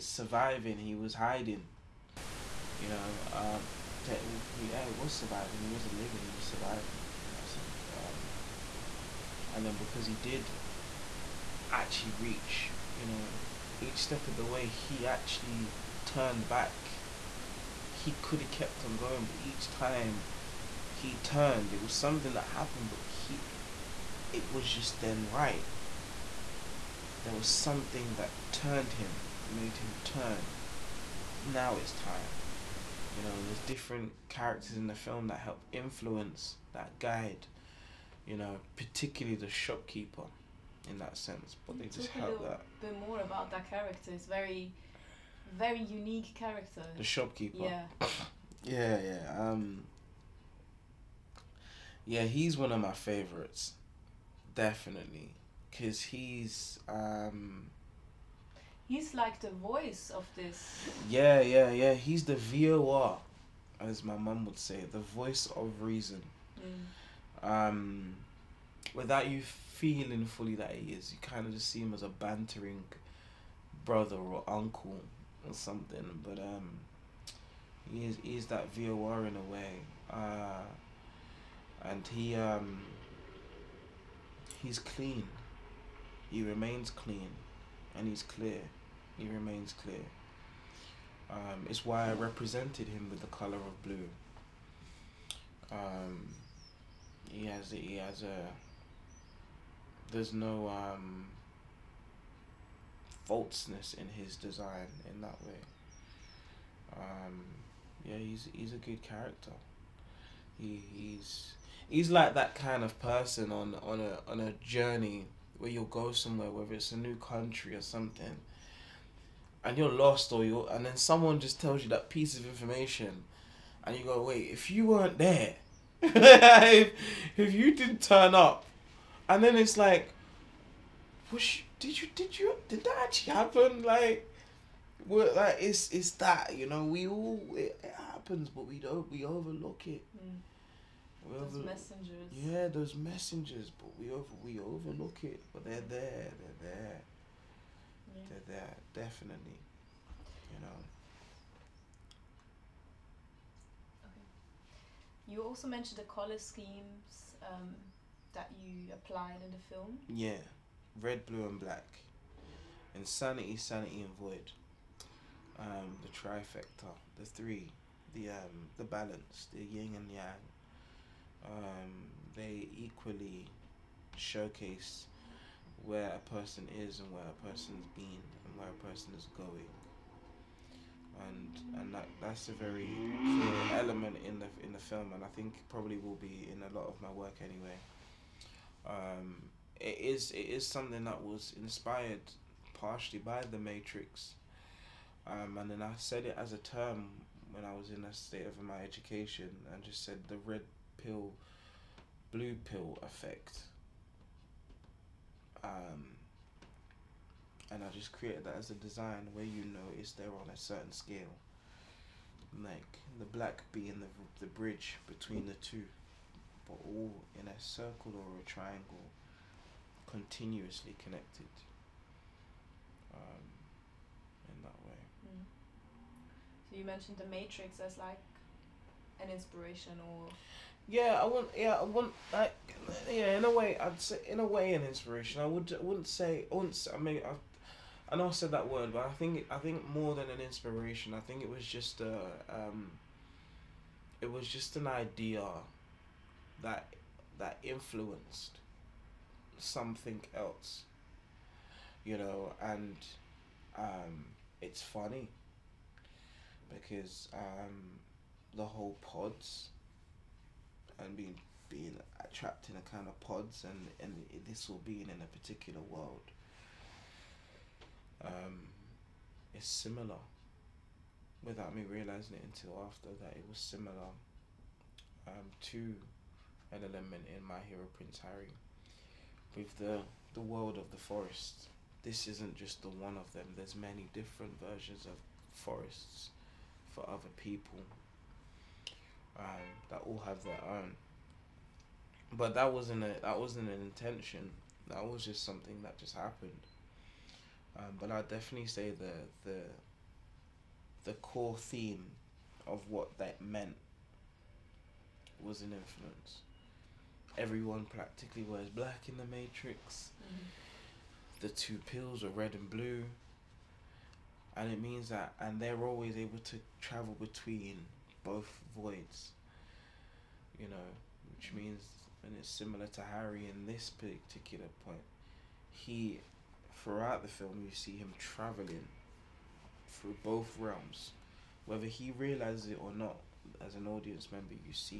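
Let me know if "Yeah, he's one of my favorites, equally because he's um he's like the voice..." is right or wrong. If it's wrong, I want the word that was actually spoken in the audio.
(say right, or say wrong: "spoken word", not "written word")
wrong: "definitely", not "equally".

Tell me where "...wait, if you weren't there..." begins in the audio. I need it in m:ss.
2:04.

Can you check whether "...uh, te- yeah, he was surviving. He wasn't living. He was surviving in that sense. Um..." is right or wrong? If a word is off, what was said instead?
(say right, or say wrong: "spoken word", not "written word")
right.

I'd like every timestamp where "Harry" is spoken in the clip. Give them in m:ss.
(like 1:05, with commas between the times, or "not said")
4:38, 5:23.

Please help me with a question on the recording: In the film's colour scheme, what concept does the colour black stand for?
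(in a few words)
Void.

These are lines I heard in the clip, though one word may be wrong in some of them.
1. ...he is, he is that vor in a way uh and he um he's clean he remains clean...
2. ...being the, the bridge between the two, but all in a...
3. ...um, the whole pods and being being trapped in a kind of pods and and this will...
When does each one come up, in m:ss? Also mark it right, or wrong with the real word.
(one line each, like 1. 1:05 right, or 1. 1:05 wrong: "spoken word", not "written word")
1. 1:17 right
2. 3:33 right
3. 4:17 right.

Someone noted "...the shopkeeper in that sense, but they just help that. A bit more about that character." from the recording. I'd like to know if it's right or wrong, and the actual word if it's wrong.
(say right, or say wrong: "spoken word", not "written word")
right.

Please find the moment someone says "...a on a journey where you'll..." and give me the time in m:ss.
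1:53.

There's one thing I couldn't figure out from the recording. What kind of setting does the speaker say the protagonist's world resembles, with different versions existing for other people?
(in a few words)
The forest.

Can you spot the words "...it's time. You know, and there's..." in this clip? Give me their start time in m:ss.
0:31.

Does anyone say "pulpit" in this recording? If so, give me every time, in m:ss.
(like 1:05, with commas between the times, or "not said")
not said.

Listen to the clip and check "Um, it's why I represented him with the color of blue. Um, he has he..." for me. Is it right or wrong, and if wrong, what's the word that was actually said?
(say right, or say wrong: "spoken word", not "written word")
right.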